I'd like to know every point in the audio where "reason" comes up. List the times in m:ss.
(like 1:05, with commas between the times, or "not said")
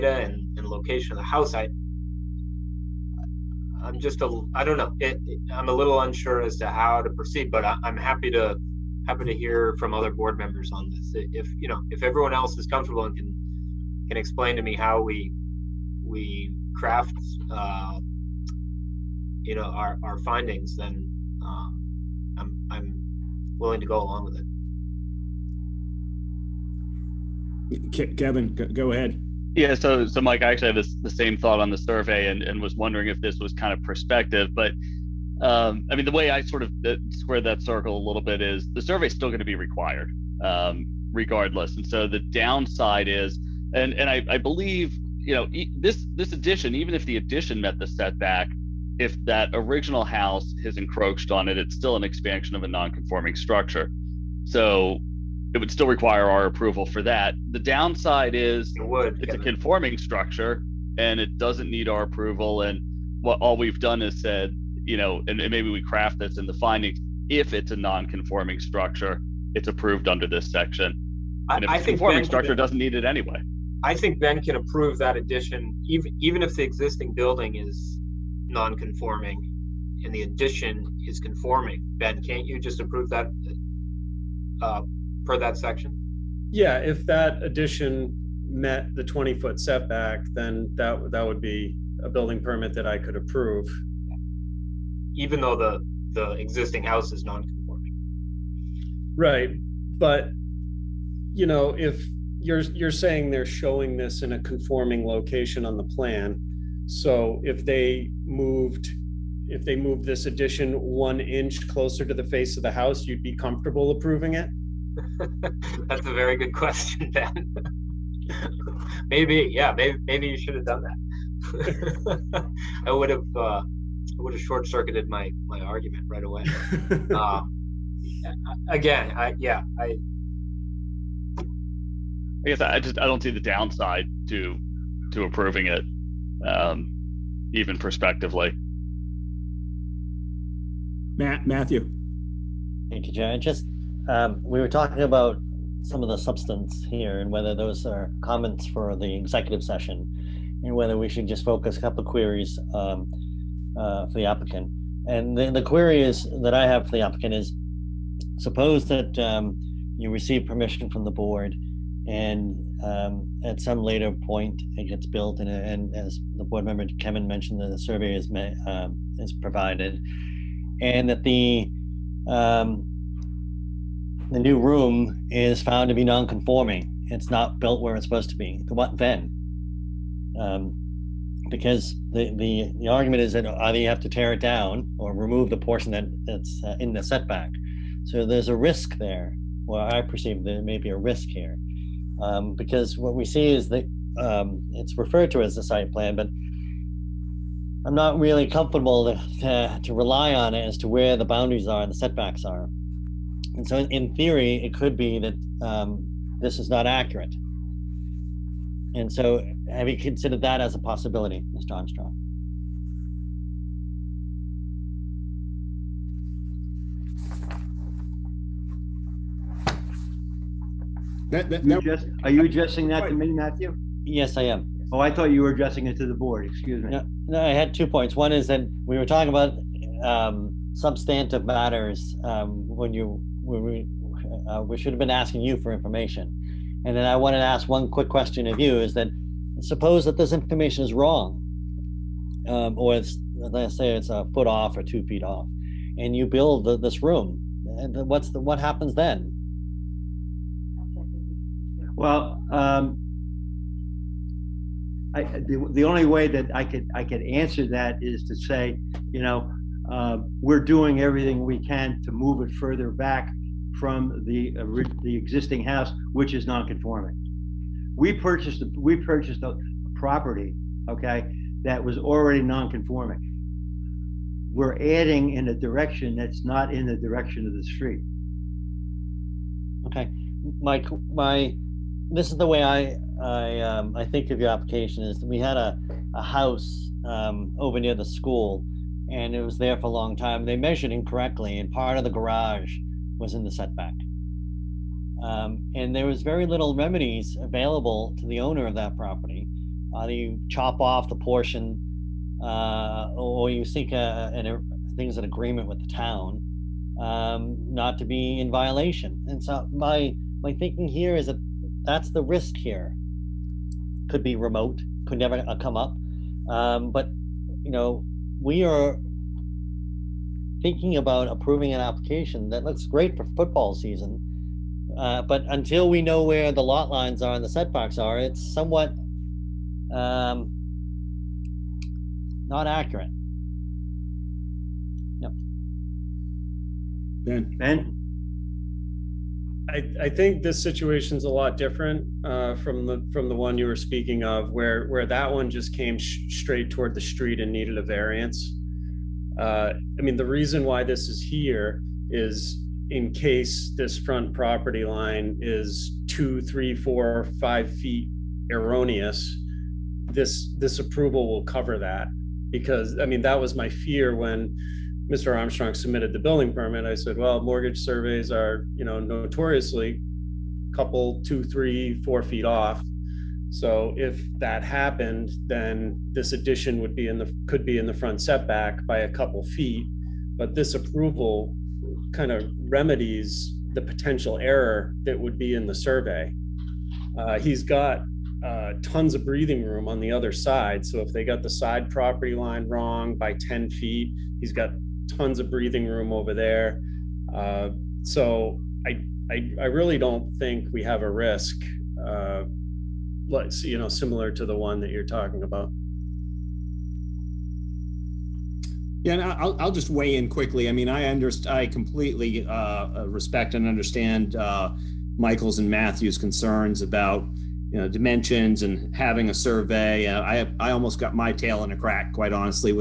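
5:50.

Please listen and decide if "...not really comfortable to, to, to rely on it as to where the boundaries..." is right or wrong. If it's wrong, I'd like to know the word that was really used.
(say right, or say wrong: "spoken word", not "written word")
right.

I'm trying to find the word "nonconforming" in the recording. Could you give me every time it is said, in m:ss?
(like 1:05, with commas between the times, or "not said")
4:26, 4:32.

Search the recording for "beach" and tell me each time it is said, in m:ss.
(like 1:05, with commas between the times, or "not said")
not said.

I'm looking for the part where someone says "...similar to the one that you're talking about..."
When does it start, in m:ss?
6:43.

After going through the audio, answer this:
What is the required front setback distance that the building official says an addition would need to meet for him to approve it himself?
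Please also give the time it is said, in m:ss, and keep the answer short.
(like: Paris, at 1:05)
20 feet, at 1:29.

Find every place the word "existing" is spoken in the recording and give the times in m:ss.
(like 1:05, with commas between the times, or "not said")
1:16, 1:36, 4:25.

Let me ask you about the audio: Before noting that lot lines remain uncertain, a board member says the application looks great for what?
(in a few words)
football season.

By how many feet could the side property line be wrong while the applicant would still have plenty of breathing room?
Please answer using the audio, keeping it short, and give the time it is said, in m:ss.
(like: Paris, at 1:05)
10, at 6:33.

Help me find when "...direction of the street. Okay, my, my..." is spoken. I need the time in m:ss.
4:36.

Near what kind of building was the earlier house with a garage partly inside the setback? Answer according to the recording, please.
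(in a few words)
the school.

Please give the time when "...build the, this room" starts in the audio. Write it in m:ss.
4:06.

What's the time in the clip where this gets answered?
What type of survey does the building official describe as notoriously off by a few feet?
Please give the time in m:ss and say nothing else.
6:07.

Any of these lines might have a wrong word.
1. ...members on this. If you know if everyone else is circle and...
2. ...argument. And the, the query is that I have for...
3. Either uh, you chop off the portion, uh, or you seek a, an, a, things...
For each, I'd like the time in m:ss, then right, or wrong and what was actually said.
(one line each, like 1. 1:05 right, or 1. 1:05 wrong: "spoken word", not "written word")
1. 0:10 wrong: "comfortable", not "circle"
2. 2:34 wrong: "applicant", not "argument"
3. 4:59 right.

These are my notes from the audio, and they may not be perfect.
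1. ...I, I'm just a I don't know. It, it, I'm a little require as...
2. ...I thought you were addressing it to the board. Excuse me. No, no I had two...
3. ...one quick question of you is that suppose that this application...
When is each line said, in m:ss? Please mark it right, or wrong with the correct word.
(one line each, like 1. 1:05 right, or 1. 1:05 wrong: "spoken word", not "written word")
1. 0:01 wrong: "unsure", not "require"
2. 3:44 right
3. 3:57 wrong: "information", not "application".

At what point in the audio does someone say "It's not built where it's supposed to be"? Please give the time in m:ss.
2:57.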